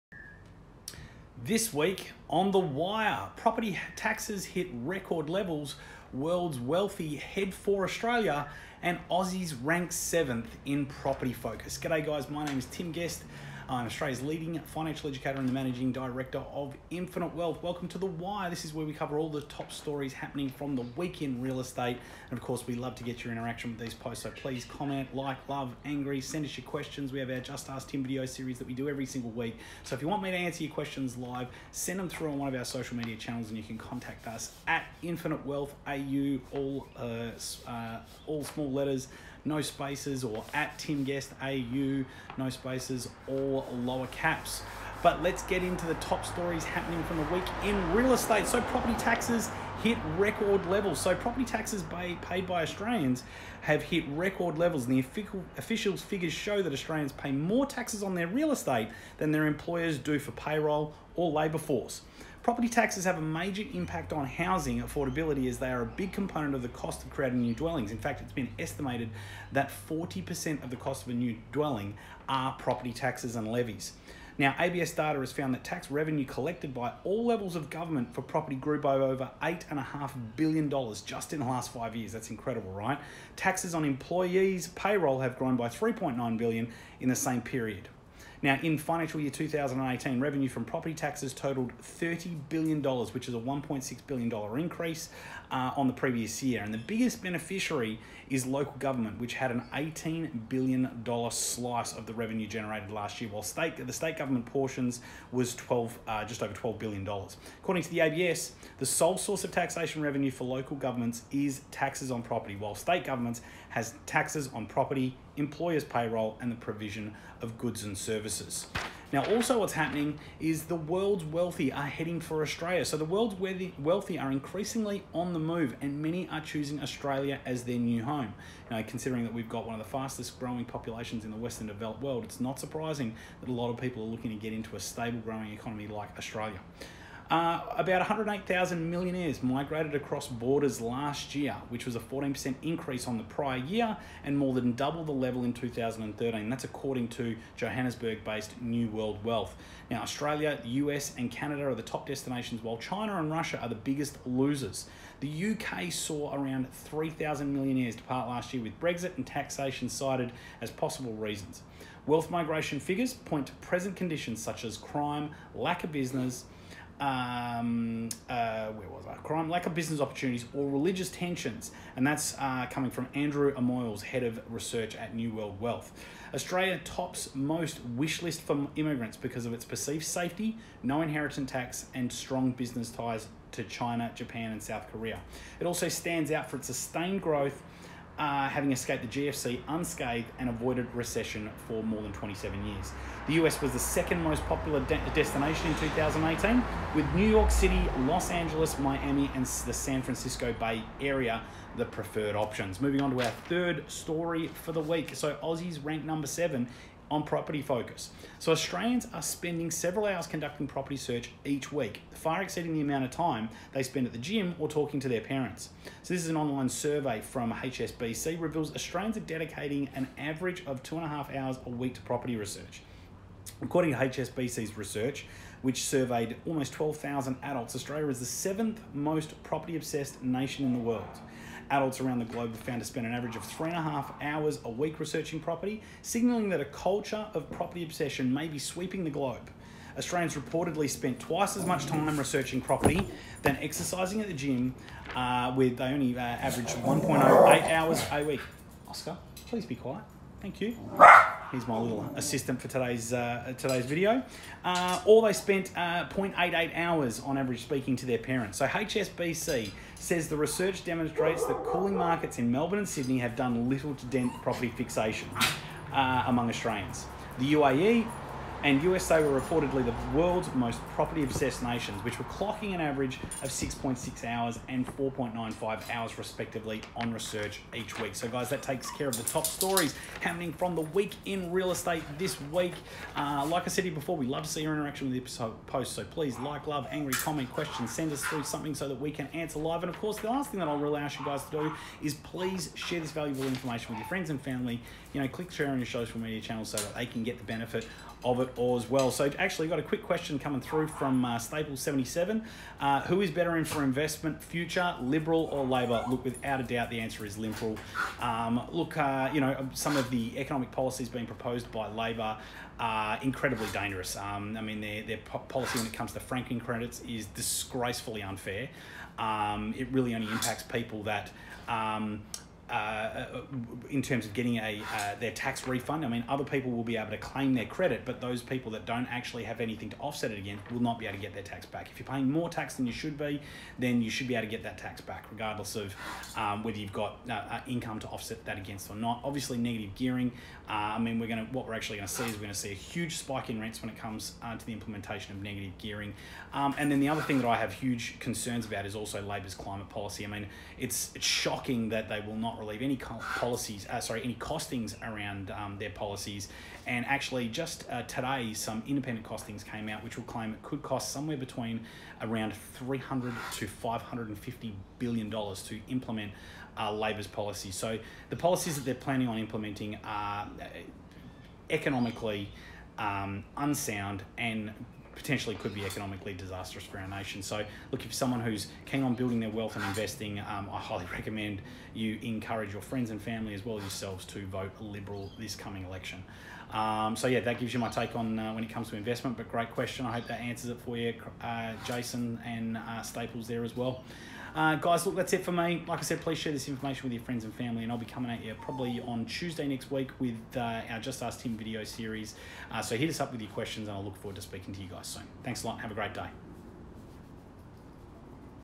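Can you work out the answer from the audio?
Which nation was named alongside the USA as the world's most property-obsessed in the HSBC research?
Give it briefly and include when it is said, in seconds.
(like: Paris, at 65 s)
UAE, at 267 s.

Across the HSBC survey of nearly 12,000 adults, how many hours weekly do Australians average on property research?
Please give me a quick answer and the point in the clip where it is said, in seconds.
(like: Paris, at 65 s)
2.5 hours, at 220 s.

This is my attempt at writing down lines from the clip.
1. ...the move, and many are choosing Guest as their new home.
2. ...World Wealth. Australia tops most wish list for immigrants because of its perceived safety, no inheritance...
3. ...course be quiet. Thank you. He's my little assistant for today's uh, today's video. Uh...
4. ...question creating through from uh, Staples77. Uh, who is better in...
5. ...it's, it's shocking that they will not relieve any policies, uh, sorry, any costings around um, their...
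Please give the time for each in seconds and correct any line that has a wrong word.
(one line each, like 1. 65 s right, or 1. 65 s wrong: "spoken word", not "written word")
1. 125 s wrong: "Australia", not "Guest"
2. 175 s right
3. 249 s wrong: "please", not "course"
4. 300 s wrong: "coming", not "creating"
5. 350 s right.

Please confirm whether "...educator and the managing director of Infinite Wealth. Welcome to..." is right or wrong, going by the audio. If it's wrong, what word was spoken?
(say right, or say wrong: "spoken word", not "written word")
right.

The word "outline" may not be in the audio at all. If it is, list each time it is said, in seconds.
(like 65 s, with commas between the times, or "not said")
not said.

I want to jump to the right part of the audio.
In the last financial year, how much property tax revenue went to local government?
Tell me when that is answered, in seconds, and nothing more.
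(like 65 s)
99 s.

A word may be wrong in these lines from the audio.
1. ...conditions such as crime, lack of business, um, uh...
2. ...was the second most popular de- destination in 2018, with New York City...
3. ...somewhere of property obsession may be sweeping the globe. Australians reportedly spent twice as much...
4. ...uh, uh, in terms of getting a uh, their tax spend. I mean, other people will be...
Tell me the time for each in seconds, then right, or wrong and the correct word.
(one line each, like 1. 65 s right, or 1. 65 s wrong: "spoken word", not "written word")
1. 163 s right
2. 193 s right
3. 236 s wrong: "culture", not "somewhere"
4. 322 s wrong: "refund", not "spend".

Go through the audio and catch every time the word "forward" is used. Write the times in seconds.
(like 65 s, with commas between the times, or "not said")
404 s.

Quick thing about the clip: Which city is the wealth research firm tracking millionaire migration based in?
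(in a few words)
Johannesburg.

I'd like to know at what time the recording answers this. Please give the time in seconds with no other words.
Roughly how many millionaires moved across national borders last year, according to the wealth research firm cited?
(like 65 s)
138 s.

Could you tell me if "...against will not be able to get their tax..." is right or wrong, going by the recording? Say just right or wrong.
right.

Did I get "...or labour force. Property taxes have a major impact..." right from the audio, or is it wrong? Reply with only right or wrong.
right.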